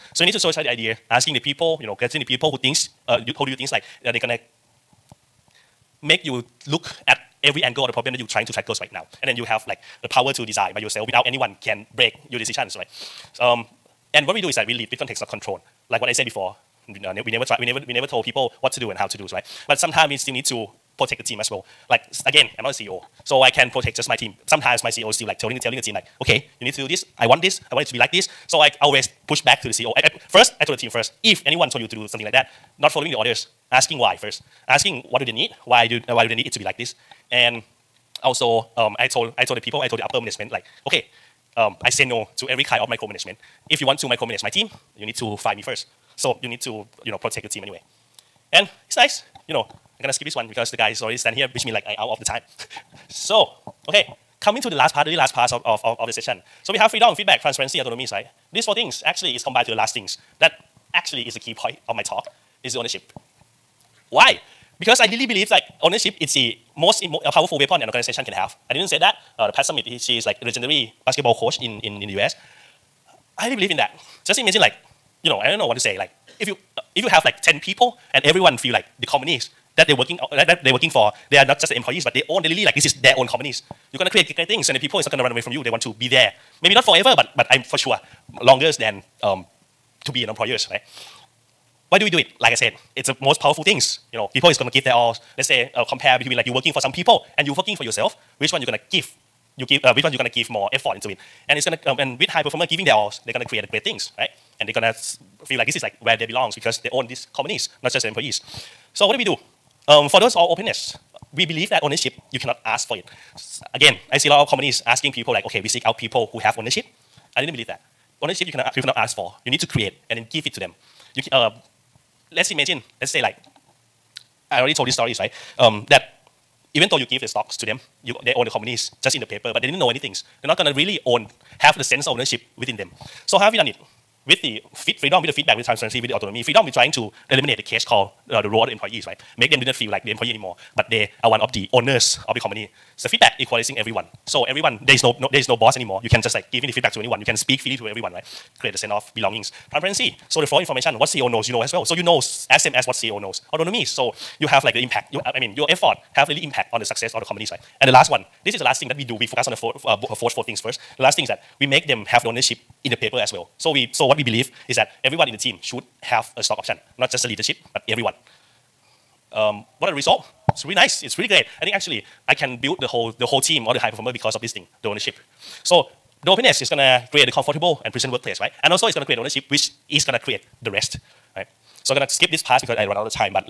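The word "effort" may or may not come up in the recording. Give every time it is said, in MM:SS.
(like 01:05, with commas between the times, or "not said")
01:40, 02:35.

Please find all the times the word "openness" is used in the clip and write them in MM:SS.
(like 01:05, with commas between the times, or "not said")
01:50, 02:56.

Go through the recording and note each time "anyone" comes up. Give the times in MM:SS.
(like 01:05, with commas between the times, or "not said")
00:11, 00:31, 02:26.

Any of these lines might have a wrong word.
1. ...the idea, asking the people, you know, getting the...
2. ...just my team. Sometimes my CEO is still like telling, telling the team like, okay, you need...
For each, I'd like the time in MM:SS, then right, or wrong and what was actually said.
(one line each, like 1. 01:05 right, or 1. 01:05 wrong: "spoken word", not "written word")
1. 00:00 right
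2. 00:23 right.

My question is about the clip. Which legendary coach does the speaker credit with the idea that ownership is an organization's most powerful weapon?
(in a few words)
Pat Summitt.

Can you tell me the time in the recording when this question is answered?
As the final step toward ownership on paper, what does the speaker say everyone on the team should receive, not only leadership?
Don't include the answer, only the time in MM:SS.
02:46.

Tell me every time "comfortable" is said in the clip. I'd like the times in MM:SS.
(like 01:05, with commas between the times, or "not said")
02:57.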